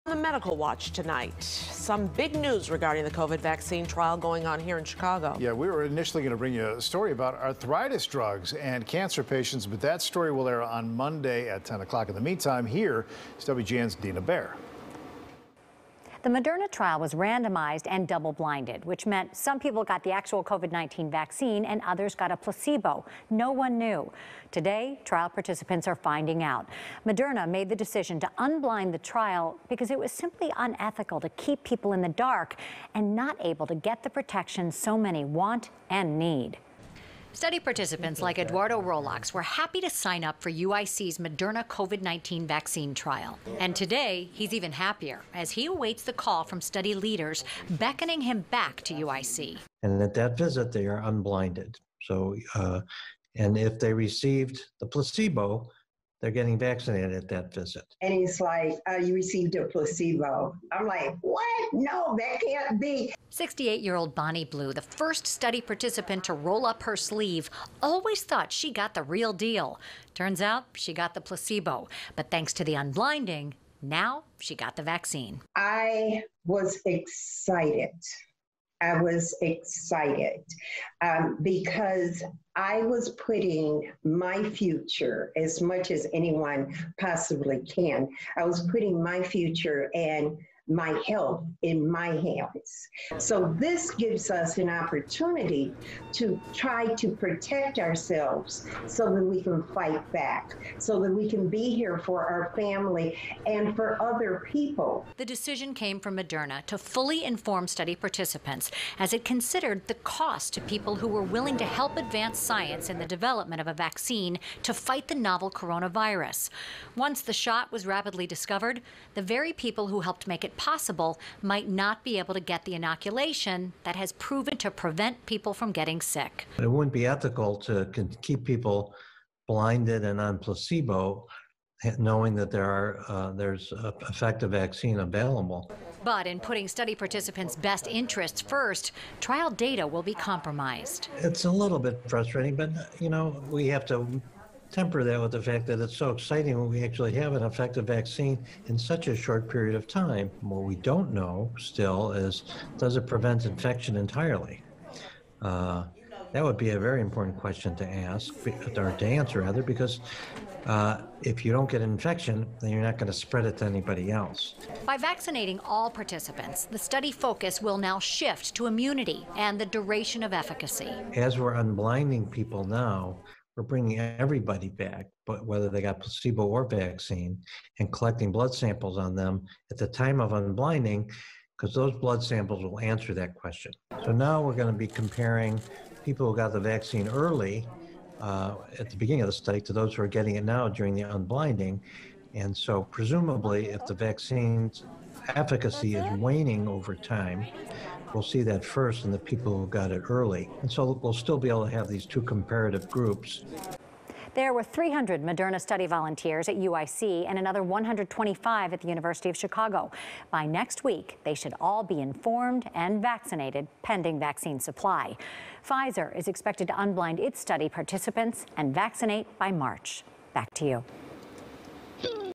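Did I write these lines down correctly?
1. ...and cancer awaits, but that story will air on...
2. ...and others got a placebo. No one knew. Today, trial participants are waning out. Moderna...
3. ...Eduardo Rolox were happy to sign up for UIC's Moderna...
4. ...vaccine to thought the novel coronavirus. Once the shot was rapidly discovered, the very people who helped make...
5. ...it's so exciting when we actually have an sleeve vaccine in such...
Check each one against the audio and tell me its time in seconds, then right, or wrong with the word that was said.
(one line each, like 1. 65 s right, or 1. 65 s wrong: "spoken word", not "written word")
1. 8 s wrong: "patients", not "awaits"
2. 21 s wrong: "finding", not "waning"
3. 38 s right
4. 113 s wrong: "fight", not "thought"
5. 145 s wrong: "effective", not "sleeve".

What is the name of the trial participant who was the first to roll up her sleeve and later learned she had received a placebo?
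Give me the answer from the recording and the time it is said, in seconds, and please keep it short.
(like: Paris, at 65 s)
Bonnie Blue, at 64 s.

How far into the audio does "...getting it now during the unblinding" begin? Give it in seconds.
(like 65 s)
190 s.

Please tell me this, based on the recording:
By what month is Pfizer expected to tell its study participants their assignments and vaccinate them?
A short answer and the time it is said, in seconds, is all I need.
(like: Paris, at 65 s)
March, at 219 s.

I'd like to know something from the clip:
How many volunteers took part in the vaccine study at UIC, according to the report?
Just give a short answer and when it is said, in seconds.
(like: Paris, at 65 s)
300, at 204 s.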